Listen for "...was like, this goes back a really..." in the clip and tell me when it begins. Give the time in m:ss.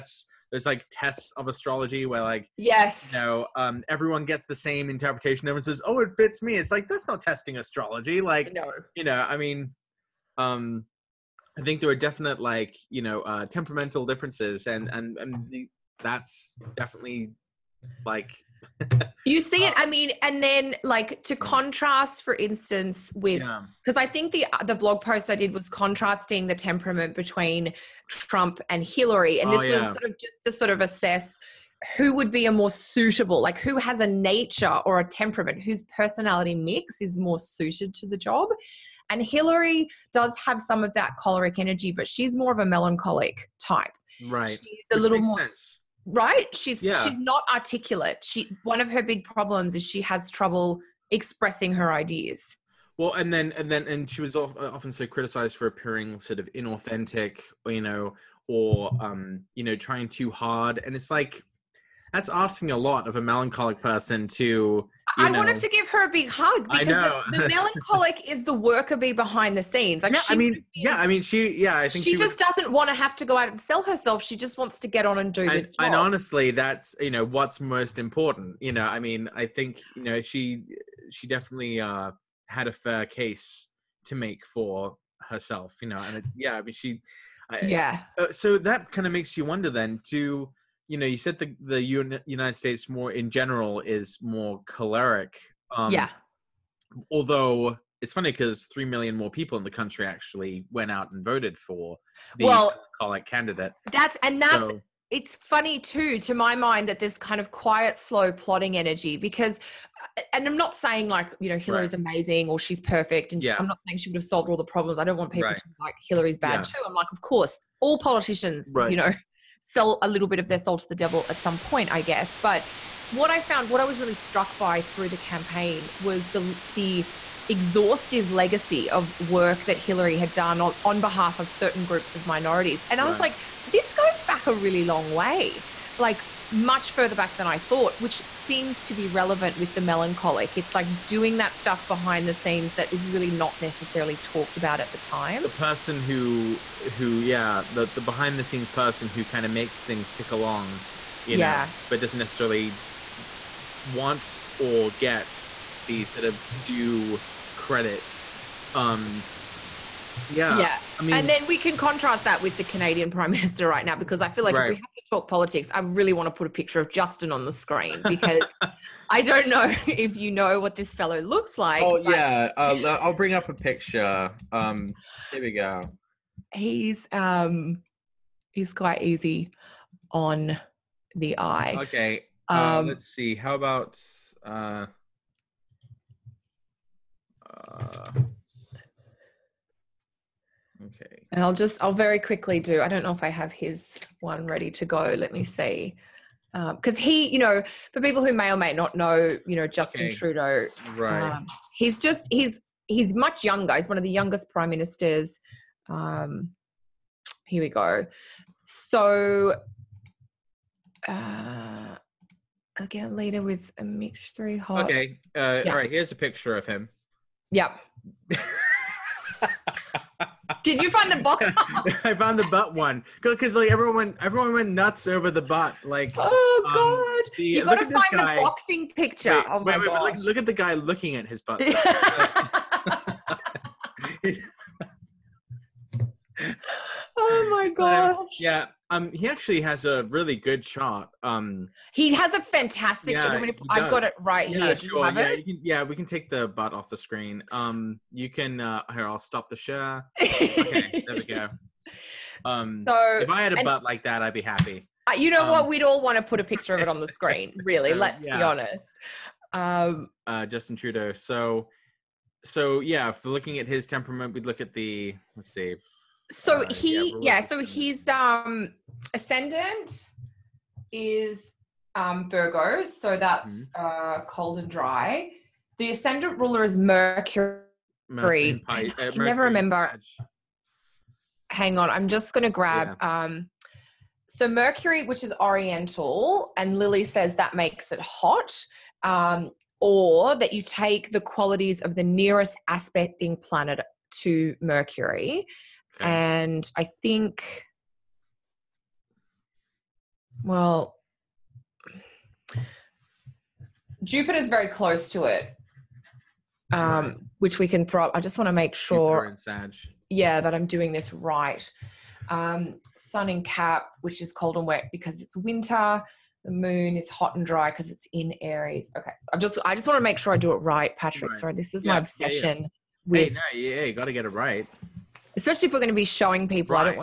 2:13.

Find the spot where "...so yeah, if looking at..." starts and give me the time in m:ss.
4:22.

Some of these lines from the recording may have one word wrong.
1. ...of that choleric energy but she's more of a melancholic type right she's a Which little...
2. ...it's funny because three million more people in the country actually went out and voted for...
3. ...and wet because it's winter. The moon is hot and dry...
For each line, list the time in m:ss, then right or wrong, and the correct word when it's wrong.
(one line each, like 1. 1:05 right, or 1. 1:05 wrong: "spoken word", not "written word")
1. 0:40 right
2. 1:38 right
3. 5:14 right.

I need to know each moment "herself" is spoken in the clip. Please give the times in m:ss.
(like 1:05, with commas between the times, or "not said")
1:13, 1:25.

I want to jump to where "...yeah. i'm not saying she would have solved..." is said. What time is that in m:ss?
1:53.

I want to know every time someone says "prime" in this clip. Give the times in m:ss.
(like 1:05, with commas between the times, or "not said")
2:43, 3:24.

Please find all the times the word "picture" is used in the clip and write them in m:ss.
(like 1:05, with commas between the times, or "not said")
2:46, 2:53, 3:36, 3:48, 4:16.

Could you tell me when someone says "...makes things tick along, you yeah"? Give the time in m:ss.
2:29.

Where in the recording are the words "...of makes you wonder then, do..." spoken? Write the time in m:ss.
1:29.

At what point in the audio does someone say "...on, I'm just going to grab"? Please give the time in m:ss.
4:41.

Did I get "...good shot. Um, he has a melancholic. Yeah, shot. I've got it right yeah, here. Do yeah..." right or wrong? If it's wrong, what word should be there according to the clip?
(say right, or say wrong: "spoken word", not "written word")
wrong: "fantastic", not "melancholic".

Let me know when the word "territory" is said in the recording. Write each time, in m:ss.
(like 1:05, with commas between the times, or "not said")
not said.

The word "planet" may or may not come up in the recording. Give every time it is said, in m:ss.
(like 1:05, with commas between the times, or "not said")
4:53.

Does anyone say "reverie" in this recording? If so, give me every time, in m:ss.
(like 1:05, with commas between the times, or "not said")
not said.